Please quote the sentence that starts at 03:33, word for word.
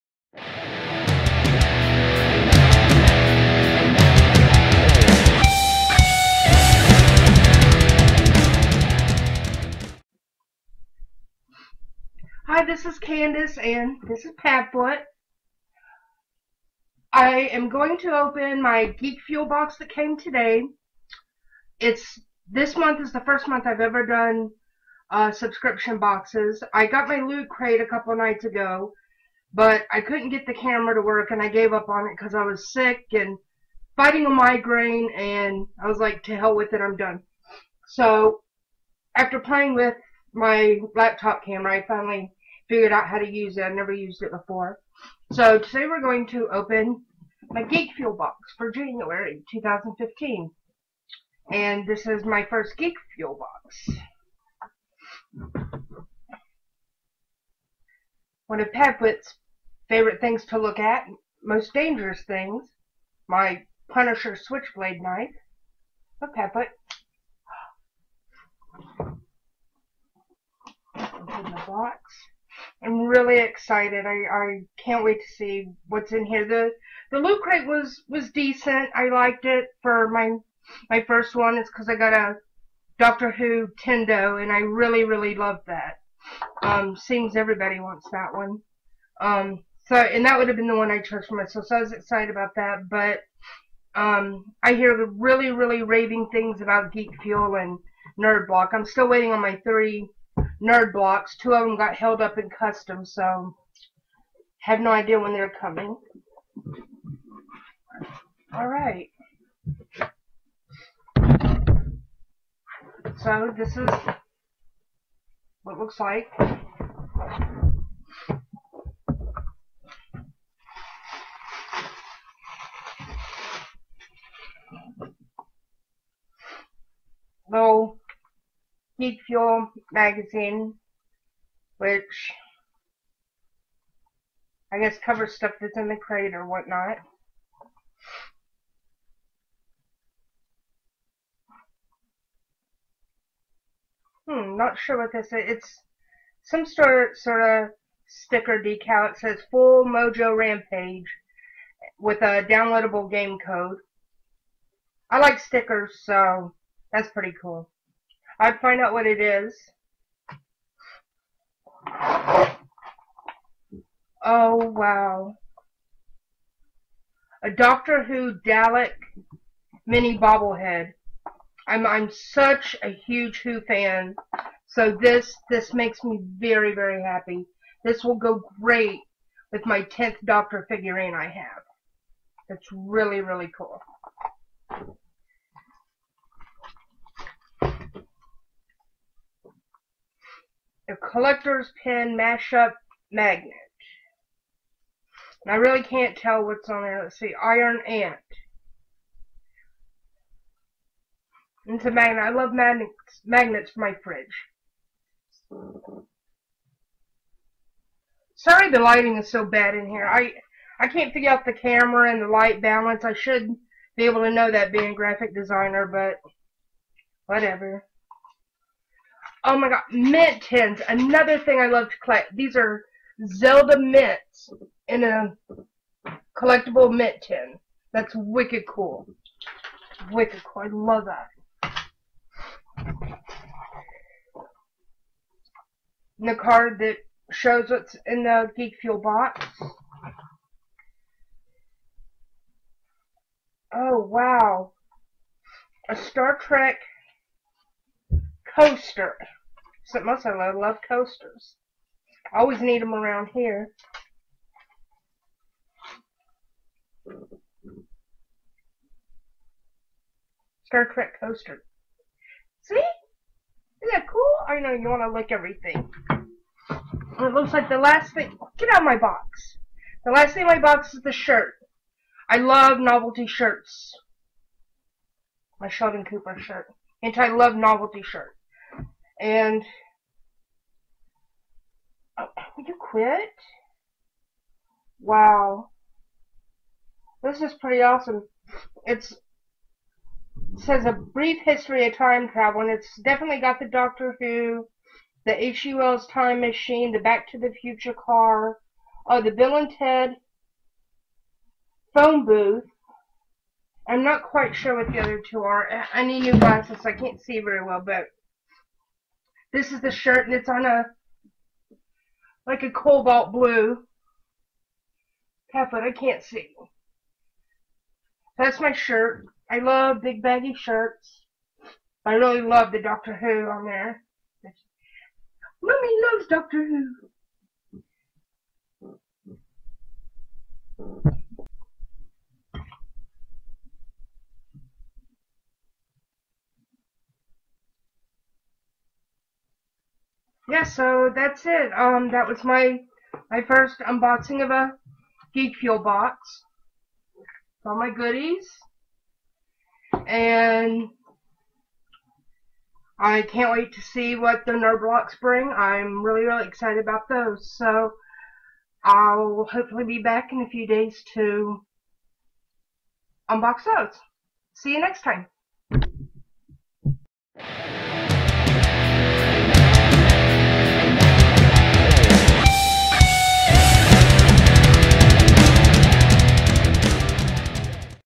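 I should be able to know that being graphic designer, but whatever.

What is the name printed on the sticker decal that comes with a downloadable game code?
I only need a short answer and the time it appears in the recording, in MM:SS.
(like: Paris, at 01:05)
Full Mojo Rampage, at 02:29.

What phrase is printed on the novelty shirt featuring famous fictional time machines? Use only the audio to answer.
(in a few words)
a brief history of time travel.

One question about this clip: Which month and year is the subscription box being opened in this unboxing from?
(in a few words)
January 2015.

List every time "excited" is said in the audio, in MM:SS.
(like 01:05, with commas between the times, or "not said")
01:13, 01:31, 05:56.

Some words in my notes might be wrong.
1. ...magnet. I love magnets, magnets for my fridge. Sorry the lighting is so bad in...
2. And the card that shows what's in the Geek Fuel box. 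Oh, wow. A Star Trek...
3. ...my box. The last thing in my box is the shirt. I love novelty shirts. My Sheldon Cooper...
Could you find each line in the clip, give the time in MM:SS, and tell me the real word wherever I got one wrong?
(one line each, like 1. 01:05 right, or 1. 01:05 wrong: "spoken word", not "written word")
1. 03:21 right
2. 03:56 right
3. 04:28 right.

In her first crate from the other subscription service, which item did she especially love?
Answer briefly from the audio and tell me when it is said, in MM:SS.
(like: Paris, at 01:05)
Doctor Who Tendo, at 01:22.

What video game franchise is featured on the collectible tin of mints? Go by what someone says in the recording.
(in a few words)
Zelda.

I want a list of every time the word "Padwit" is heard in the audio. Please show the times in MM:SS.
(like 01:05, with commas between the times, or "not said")
00:58, 01:06.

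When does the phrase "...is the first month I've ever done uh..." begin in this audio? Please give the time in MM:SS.
00:22.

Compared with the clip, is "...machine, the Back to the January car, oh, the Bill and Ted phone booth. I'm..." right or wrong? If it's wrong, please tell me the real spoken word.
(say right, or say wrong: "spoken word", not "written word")
wrong: "Future", not "January".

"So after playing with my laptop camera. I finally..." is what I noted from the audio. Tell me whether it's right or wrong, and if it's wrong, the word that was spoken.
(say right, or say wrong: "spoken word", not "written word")
right.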